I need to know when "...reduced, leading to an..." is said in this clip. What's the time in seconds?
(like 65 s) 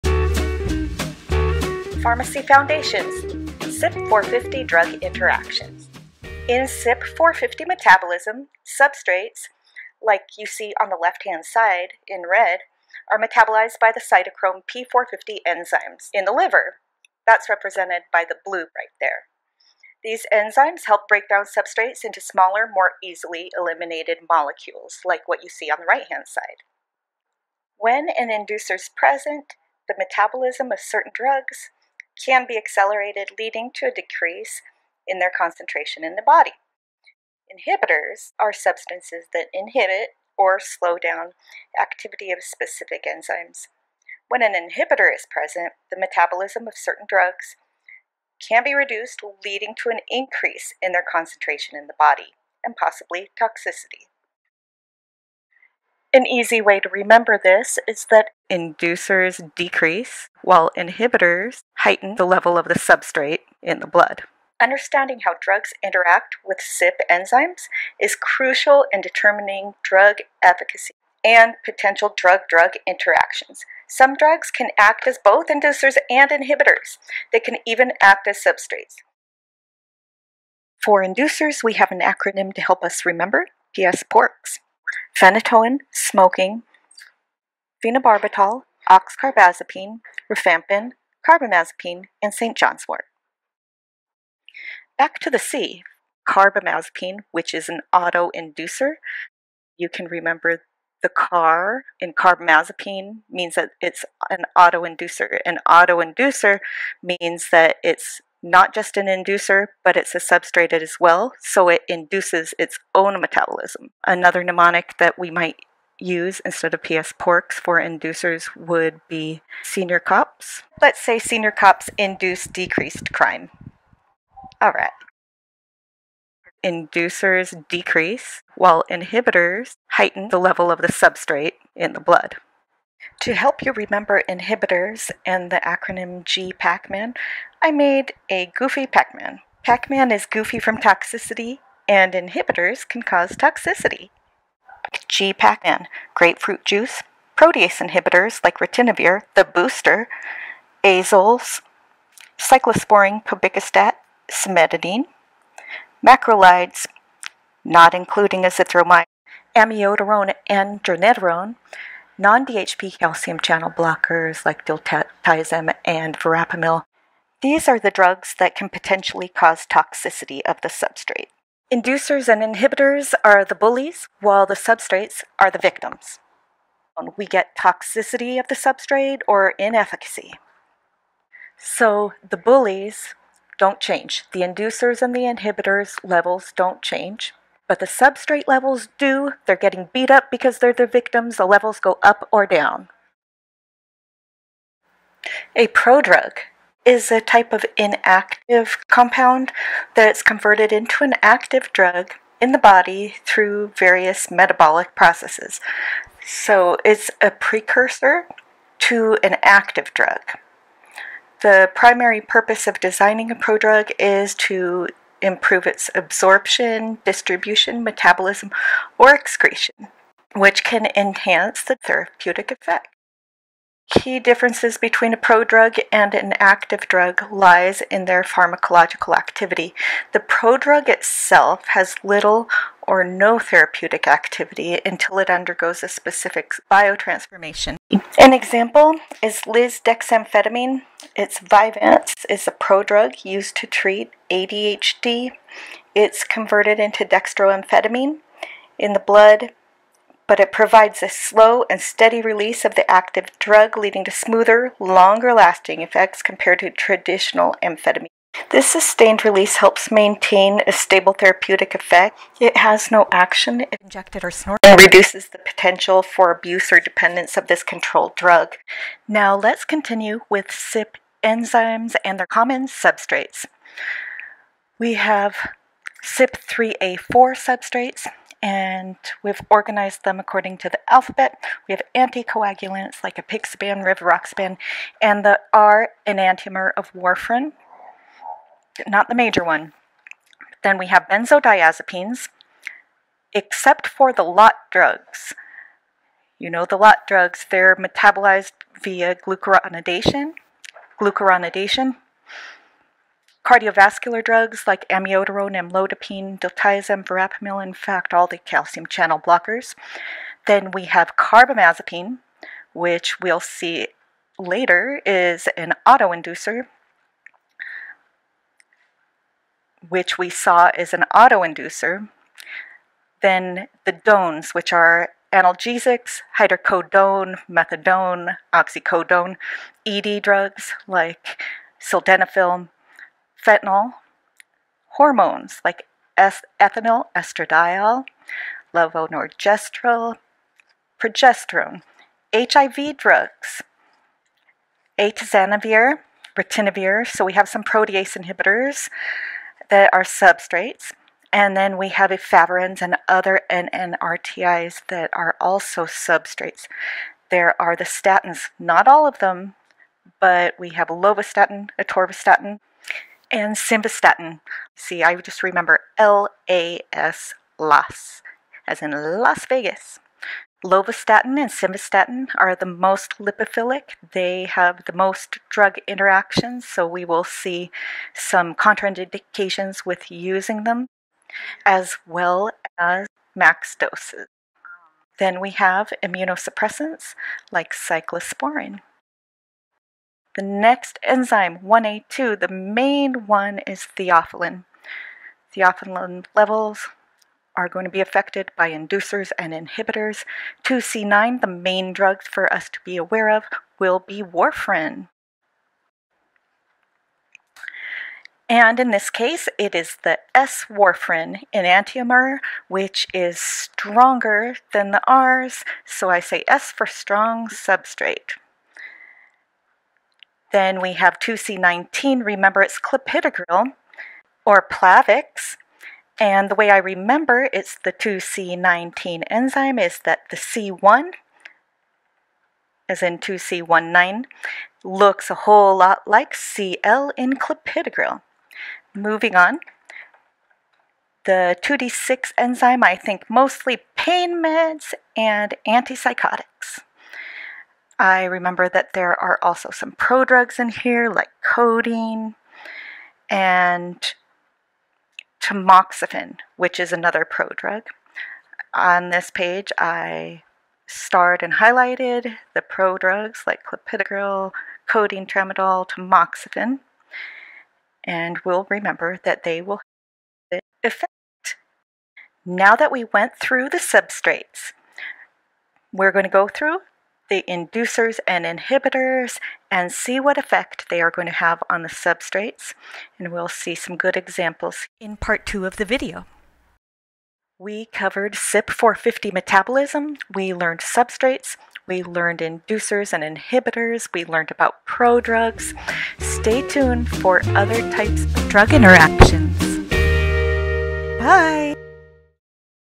48 s.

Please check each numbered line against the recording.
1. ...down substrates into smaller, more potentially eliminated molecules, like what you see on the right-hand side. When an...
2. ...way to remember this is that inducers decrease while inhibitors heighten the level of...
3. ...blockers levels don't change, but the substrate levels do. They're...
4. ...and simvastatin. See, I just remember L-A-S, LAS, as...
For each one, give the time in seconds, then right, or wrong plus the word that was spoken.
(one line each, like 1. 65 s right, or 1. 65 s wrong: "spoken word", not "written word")
1. 21 s wrong: "easily", not "potentially"
2. 56 s right
3. 185 s wrong: "inhibitors", not "blockers"
4. 363 s right.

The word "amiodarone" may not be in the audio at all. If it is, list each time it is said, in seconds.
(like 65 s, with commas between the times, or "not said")
159 s, 304 s.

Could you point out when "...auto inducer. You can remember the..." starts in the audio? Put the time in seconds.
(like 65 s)
97 s.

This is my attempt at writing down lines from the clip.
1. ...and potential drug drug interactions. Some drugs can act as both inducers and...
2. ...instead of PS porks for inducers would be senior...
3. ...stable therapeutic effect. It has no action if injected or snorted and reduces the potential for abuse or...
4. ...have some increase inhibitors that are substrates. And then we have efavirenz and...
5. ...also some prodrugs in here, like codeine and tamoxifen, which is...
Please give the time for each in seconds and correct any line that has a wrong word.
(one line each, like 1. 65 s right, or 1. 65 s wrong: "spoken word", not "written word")
1. 71 s right
2. 116 s right
3. 260 s right
4. 347 s wrong: "protease", not "increase"
5. 449 s right.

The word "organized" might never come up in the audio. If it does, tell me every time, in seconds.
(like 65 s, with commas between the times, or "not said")
279 s.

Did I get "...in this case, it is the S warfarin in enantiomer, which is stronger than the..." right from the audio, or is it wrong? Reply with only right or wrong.
right.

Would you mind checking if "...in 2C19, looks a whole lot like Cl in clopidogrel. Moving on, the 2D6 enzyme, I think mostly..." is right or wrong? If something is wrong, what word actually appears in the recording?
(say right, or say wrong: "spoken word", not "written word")
right.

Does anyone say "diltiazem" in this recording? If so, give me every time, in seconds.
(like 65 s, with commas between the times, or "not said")
164 s, 306 s.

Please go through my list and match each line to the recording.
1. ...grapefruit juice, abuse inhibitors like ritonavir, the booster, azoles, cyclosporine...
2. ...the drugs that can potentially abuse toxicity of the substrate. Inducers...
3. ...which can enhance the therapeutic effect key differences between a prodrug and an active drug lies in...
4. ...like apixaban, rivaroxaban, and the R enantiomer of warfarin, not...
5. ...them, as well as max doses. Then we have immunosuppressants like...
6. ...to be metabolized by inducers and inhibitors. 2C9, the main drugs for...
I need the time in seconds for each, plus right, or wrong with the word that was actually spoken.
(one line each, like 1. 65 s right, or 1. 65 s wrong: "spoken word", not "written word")
1. 146 s wrong: "protease", not "abuse"
2. 167 s wrong: "cause", not "abuse"
3. 220 s right
4. 283 s right
5. 380 s right
6. 397 s wrong: "affected", not "metabolized".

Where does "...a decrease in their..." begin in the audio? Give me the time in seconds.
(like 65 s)
33 s.